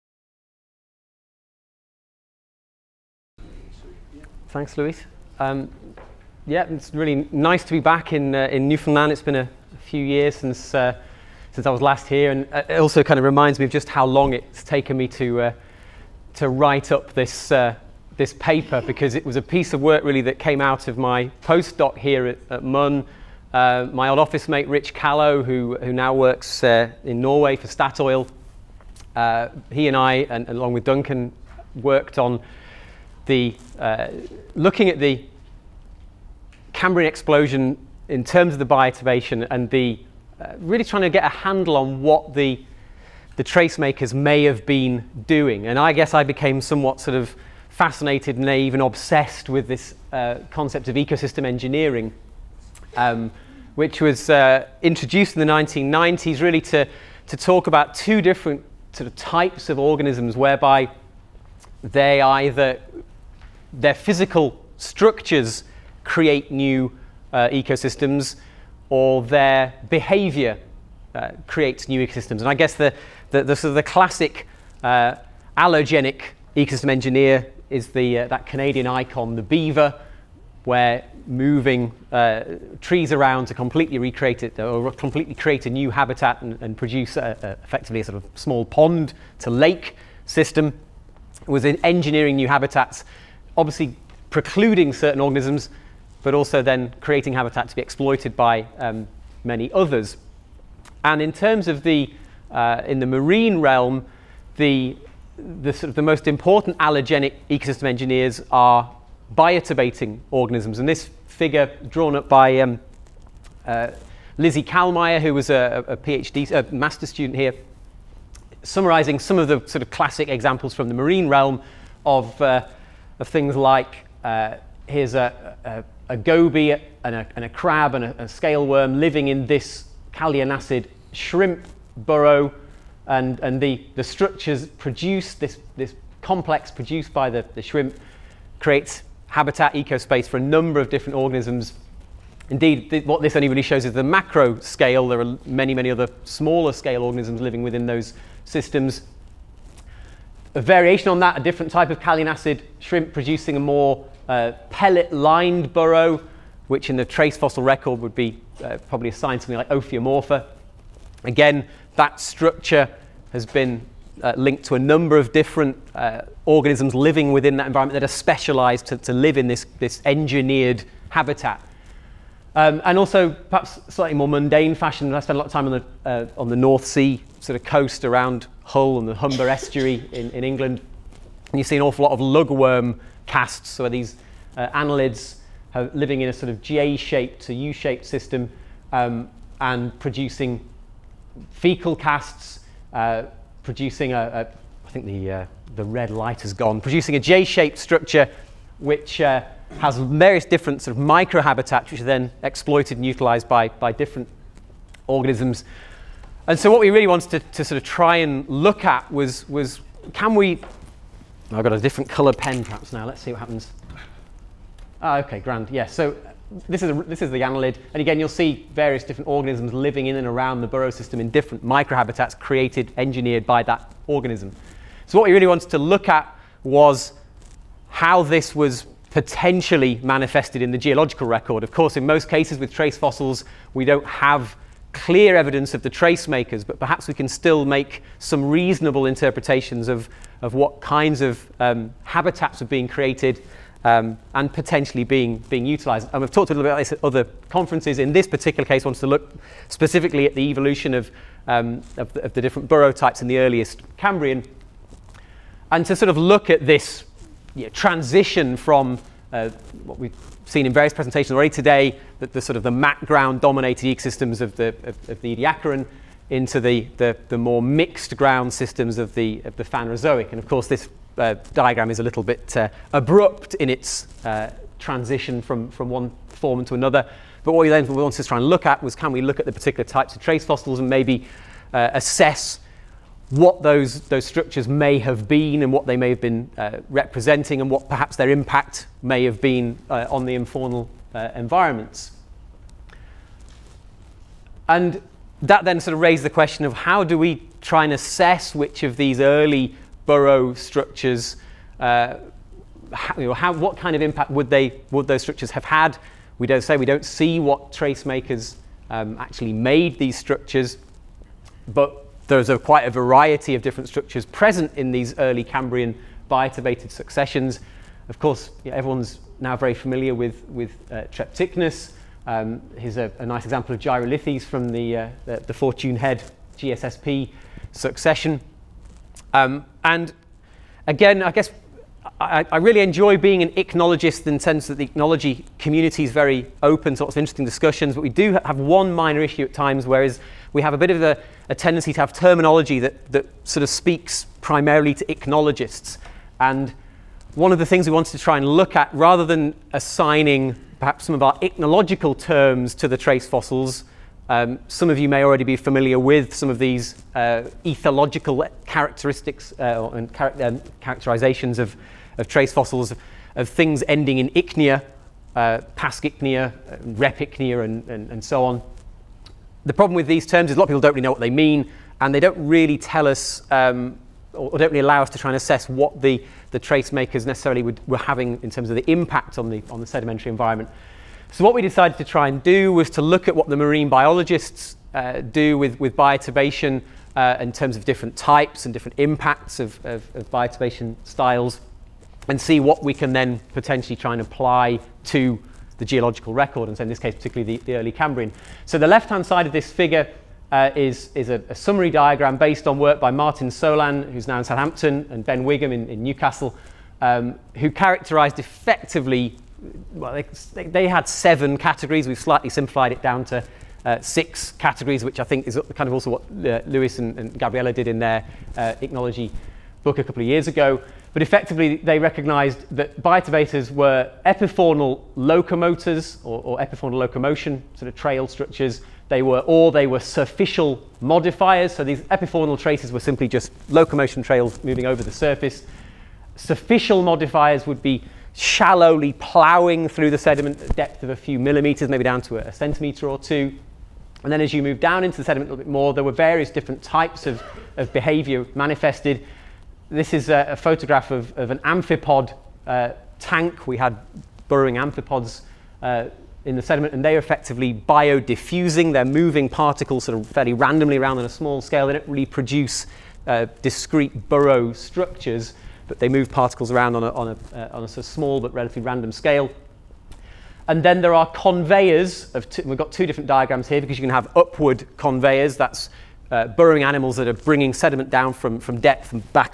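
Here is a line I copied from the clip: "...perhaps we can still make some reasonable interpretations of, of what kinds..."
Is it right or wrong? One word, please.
right.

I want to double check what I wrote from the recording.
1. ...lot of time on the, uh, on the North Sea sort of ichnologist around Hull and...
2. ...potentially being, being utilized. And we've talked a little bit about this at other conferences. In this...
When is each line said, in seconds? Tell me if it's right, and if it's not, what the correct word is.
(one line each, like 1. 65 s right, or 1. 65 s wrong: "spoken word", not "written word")
1. 175 s wrong: "coast", not "ichnologist"
2. 244 s right.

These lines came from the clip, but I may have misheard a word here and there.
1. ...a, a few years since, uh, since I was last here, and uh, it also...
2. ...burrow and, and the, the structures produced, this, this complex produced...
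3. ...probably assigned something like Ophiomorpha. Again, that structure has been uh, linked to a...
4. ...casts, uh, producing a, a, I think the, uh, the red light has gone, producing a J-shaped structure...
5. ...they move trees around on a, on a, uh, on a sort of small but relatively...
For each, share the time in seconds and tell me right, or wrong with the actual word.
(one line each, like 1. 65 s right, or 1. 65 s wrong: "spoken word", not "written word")
1. 9 s right
2. 131 s right
3. 158 s right
4. 191 s right
5. 465 s wrong: "particles", not "trees".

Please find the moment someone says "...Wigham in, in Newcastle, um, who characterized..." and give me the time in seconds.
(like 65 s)
405 s.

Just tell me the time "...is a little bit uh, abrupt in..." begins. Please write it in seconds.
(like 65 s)
271 s.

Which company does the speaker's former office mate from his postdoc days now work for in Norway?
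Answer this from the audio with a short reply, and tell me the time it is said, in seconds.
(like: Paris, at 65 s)
Statoil, at 27 s.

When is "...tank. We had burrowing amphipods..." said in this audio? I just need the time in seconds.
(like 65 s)
453 s.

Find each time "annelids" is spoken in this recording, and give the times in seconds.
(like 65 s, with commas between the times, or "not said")
184 s, 217 s.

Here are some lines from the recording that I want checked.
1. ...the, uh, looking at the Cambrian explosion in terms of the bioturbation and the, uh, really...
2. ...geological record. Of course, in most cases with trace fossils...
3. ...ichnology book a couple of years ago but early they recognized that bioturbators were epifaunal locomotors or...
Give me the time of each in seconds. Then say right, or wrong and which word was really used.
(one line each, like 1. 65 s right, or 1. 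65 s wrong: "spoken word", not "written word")
1. 33 s right
2. 230 s right
3. 418 s wrong: "effectively", not "early".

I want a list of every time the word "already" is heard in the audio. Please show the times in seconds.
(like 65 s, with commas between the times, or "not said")
261 s, 355 s.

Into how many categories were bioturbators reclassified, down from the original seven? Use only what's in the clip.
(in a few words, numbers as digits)
6.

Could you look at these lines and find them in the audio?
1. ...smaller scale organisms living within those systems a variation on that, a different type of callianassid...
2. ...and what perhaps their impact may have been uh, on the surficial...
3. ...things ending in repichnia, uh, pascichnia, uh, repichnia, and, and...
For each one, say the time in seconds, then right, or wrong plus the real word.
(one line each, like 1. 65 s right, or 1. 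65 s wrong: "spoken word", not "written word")
1. 146 s right
2. 287 s wrong: "infaunal", not "surficial"
3. 363 s wrong: "ichnia", not "repichnia".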